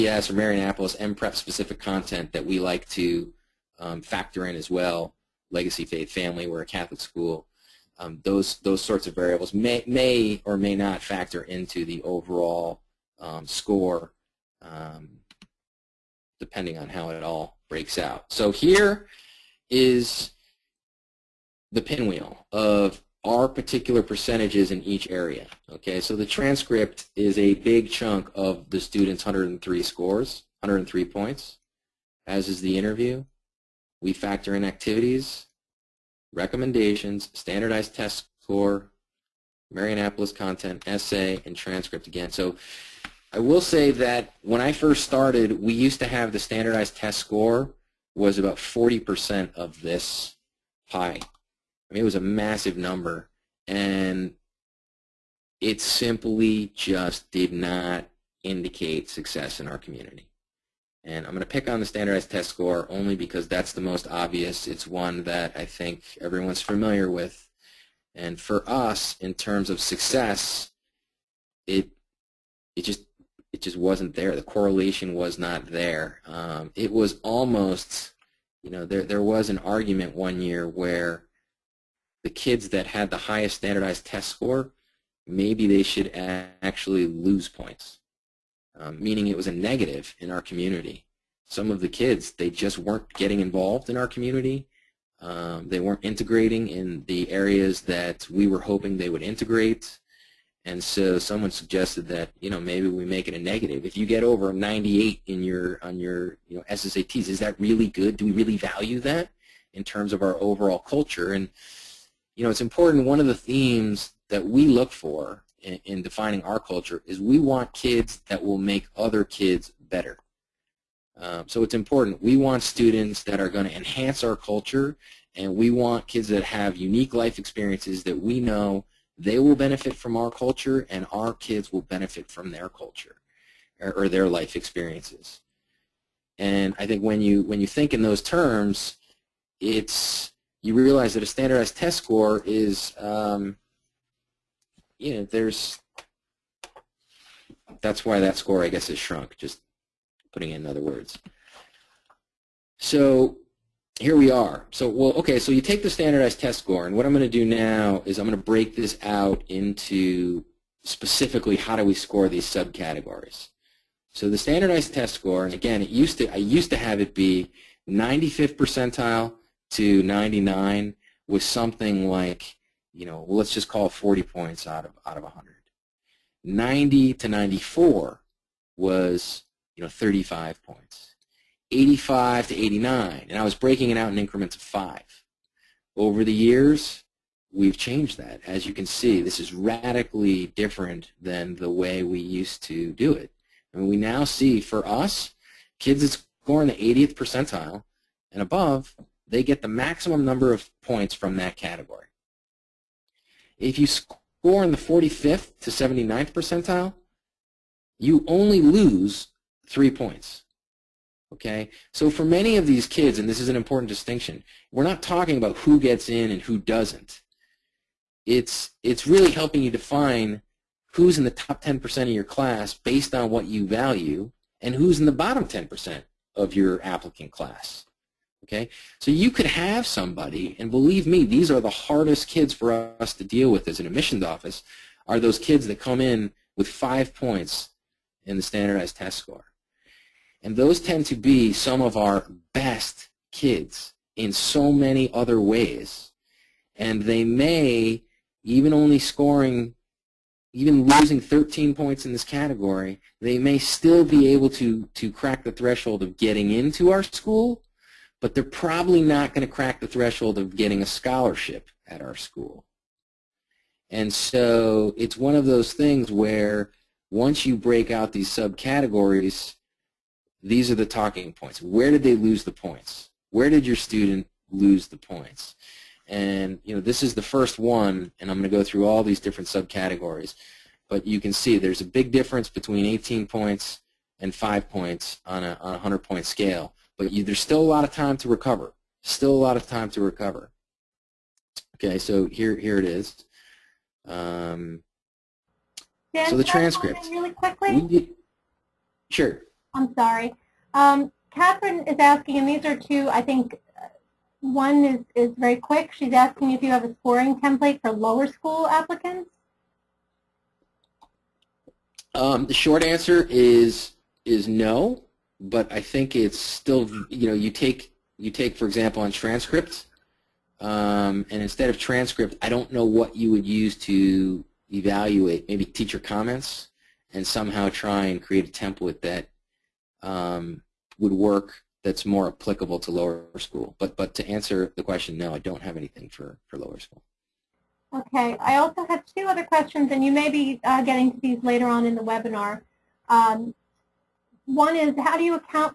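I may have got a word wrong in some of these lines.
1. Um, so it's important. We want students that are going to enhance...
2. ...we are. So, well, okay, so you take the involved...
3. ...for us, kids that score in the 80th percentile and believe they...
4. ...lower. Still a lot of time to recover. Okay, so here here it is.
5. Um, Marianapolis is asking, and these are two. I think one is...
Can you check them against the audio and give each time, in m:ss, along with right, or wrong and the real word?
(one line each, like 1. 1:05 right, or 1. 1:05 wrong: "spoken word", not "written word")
1. 2:01 right
2. 2:34 wrong: "standardized", not "involved"
3. 3:14 wrong: "above", not "believe"
4. 4:48 wrong: "recover", not "lower"
5. 5:00 wrong: "Catherine", not "Marianapolis".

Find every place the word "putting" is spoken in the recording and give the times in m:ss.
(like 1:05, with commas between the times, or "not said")
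2:30.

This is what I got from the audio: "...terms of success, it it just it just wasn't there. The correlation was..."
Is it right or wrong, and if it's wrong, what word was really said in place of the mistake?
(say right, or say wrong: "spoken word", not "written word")
right.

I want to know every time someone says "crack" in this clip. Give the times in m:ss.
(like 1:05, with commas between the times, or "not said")
4:15, 4:19.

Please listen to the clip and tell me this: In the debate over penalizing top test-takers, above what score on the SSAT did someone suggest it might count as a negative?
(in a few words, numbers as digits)
98.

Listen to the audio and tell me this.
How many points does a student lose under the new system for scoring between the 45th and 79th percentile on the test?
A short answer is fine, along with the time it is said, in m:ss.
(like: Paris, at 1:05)
3, at 3:29.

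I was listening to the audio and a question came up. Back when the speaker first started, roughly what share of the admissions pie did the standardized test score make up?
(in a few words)
40%.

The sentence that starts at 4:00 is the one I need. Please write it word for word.
And those tend to be some of our best kids in so many other ways.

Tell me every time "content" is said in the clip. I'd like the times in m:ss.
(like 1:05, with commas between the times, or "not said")
0:01, 0:40.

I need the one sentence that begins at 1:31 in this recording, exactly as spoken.
Some of the kids, they just weren't getting involved in our community.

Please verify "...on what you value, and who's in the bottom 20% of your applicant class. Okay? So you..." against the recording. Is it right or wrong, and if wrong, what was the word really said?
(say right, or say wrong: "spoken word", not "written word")
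wrong: "10", not "20".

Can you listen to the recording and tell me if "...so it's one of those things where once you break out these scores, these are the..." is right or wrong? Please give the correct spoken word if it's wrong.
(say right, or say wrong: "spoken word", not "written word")
wrong: "subcategories", not "scores".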